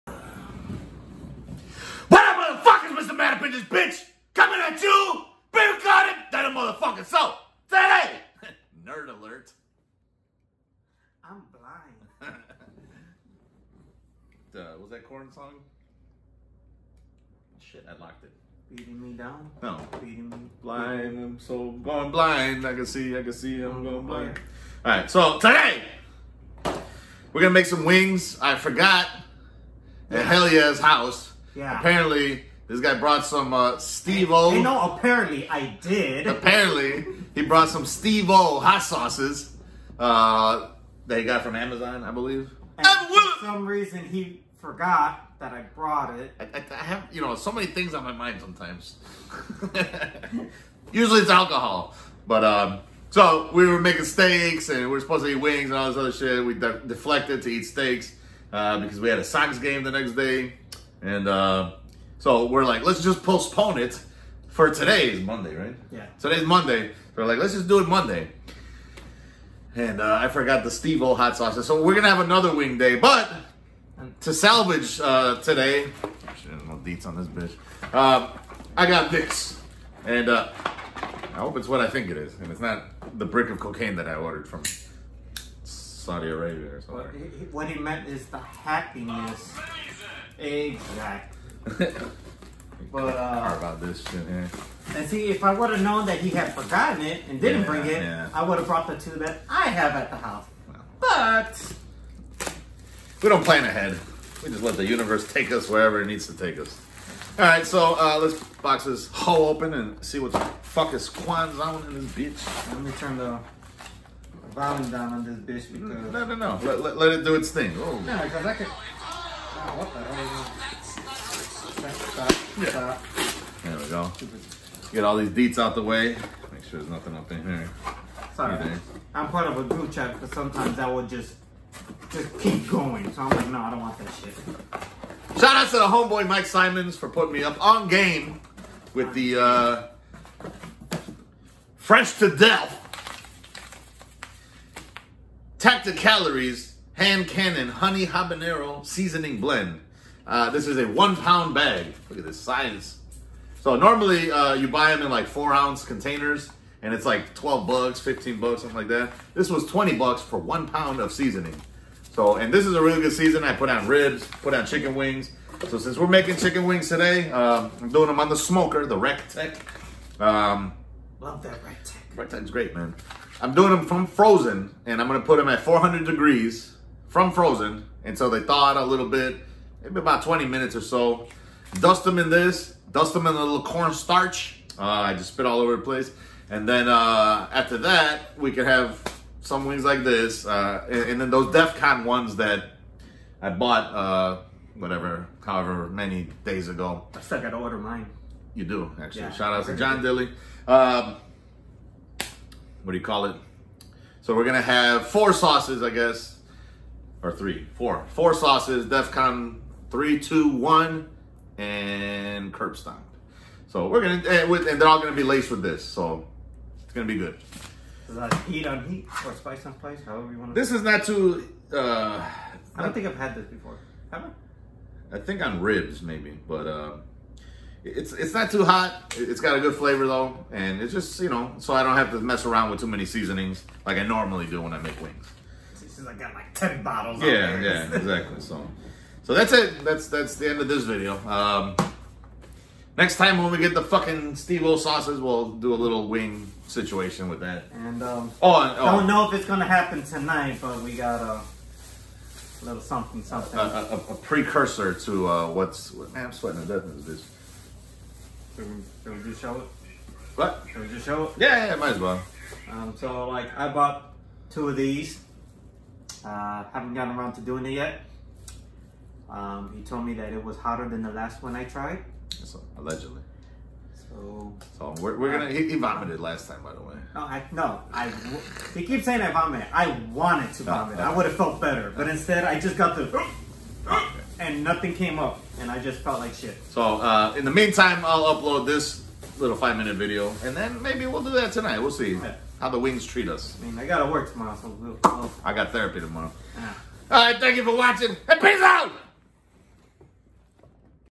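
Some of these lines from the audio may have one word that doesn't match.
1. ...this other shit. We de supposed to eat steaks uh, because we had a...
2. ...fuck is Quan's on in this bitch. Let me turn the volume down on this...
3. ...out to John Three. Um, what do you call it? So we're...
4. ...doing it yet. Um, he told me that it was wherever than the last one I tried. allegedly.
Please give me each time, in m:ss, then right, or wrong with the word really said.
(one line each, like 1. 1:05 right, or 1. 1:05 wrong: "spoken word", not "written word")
1. 0:55 wrong: "deflected", not "supposed"
2. 1:50 right
3. 3:19 wrong: "Dilly", not "Three"
4. 4:27 wrong: "hotter", not "wherever".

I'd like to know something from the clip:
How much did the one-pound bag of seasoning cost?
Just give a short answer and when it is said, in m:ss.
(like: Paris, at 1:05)
$20, at 2:39.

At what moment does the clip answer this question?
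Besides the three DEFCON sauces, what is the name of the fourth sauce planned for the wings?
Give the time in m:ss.
3:32.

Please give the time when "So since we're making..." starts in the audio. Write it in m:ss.
2:45.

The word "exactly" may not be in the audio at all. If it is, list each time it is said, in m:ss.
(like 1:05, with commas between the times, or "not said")
1:30, 3:57.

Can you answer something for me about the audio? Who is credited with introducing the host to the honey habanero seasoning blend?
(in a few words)
Mike Simons.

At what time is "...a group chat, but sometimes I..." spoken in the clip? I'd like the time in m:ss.
2:09.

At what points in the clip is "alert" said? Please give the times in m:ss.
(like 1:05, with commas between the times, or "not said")
0:09.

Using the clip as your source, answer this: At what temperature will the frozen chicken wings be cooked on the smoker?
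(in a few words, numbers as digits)
400 degrees.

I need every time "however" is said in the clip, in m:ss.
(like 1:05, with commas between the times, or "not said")
3:15, 3:40.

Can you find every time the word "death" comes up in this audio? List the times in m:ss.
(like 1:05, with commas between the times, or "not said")
2:22, 4:16.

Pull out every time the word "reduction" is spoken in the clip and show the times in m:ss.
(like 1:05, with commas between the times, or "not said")
not said.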